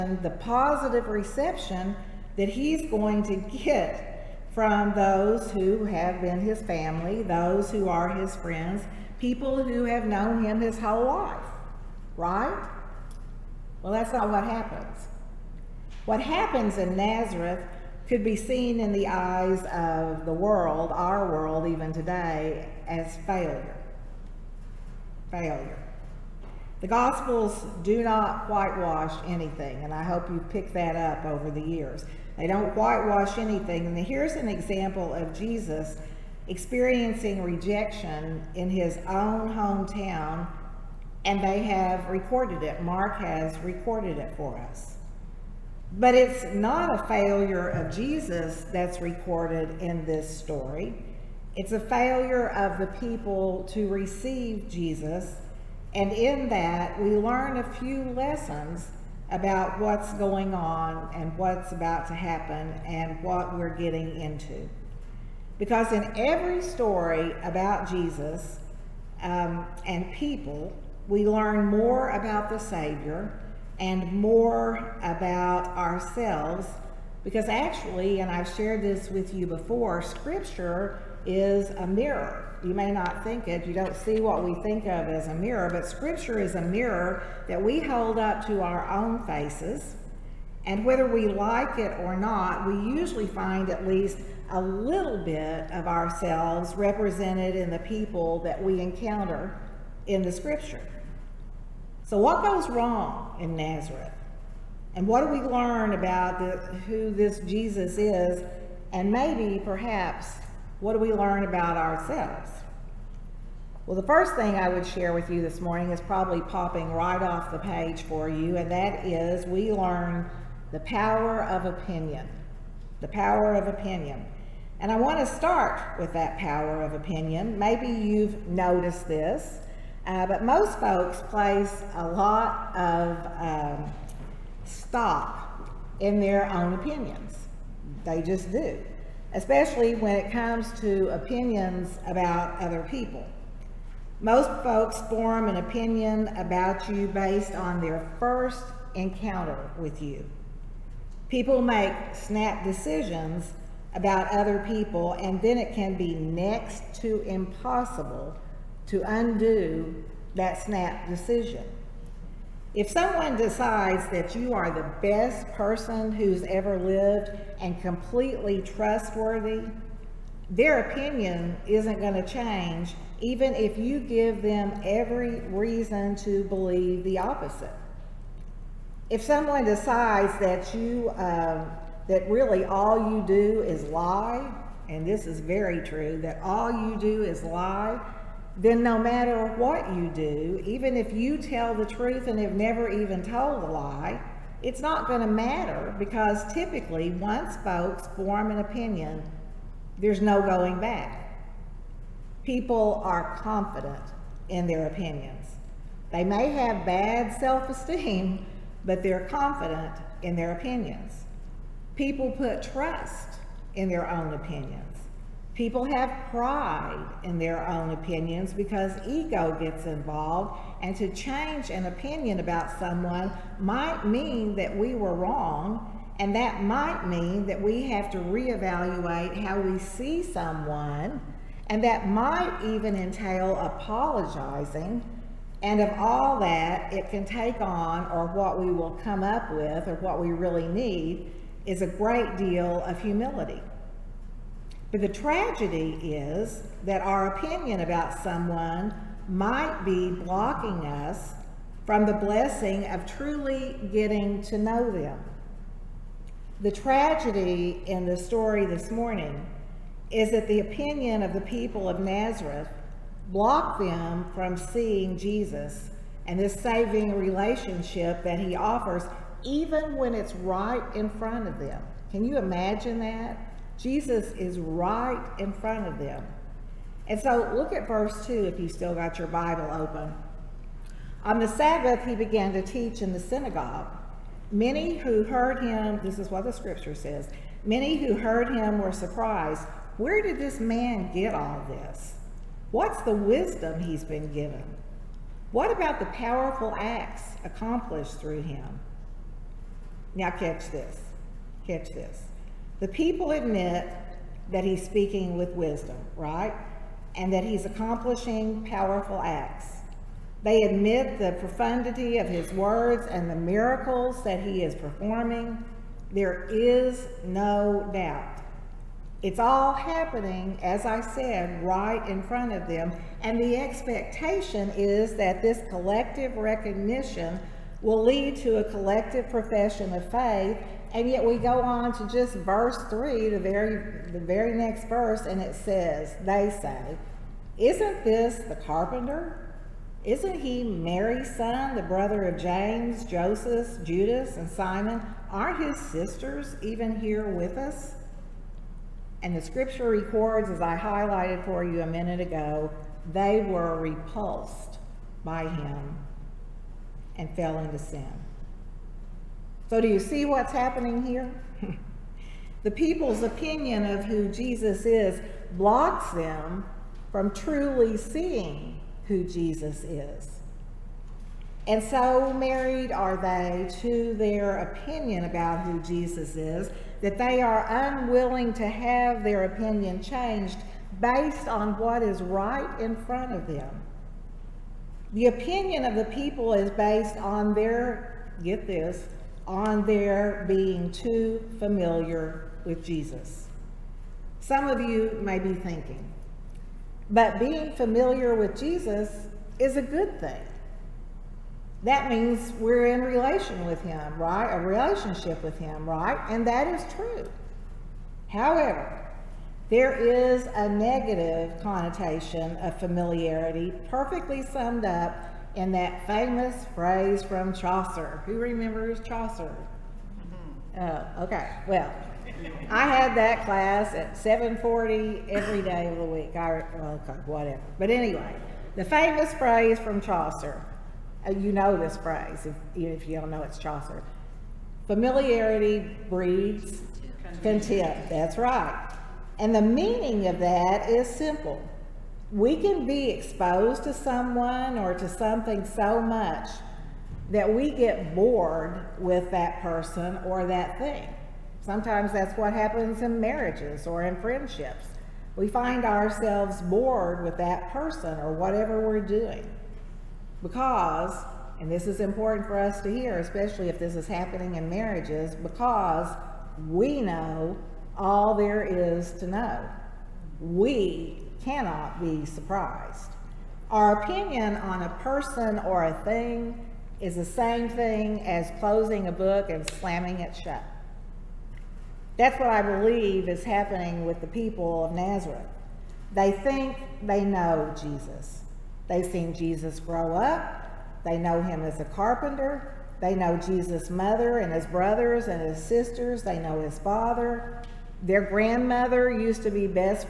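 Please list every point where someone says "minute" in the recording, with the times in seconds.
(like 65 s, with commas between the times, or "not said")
351 s.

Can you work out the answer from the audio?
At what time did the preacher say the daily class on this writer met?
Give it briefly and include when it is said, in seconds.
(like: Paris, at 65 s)
7:40, at 424 s.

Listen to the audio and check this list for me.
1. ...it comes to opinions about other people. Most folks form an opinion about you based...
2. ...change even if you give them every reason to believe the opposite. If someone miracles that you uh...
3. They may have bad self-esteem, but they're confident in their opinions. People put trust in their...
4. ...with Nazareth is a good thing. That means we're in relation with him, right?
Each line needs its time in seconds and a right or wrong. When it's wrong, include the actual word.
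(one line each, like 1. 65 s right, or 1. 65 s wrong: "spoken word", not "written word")
1. 140 s right
2. 172 s wrong: "decides", not "miracles"
3. 206 s right
4. 398 s wrong: "Jesus", not "Nazareth".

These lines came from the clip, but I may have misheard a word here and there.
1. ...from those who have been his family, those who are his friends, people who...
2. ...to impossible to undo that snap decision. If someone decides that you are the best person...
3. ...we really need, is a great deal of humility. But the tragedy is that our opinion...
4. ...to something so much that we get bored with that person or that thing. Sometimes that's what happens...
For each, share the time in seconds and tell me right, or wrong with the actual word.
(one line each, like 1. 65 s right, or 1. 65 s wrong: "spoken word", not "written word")
1. 4 s right
2. 156 s right
3. 240 s right
4. 444 s right.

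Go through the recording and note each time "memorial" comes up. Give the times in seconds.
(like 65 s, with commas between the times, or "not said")
not said.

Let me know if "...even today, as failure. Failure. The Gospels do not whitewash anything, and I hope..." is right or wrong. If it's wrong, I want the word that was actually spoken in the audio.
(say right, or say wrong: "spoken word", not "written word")
right.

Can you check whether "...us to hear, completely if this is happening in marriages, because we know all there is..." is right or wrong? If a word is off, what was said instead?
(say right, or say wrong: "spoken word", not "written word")
wrong: "especially", not "completely".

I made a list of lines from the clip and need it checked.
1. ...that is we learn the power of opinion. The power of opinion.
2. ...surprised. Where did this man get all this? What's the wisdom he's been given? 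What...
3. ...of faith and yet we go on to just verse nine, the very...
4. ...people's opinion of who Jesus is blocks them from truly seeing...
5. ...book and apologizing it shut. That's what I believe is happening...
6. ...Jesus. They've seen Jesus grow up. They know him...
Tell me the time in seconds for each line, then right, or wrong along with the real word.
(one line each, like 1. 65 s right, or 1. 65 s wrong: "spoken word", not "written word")
1. 118 s right
2. 288 s right
3. 329 s wrong: "three", not "nine"
4. 362 s right
5. 479 s wrong: "slamming", not "apologizing"
6. 487 s right.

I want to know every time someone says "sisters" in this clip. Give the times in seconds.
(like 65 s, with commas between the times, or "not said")
345 s, 495 s.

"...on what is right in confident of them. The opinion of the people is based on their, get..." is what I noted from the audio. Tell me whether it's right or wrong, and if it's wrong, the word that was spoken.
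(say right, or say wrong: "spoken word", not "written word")
wrong: "front", not "confident".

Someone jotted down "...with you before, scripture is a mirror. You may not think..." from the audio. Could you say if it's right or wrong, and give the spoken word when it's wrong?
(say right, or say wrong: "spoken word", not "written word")
right.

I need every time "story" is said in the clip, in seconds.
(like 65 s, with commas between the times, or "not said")
50 s, 66 s, 258 s.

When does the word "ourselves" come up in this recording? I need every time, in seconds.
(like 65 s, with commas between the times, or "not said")
75 s, 95 s, 111 s, 455 s.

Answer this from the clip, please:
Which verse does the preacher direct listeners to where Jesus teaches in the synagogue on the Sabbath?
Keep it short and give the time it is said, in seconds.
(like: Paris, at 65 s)
Verse 2, at 277 s.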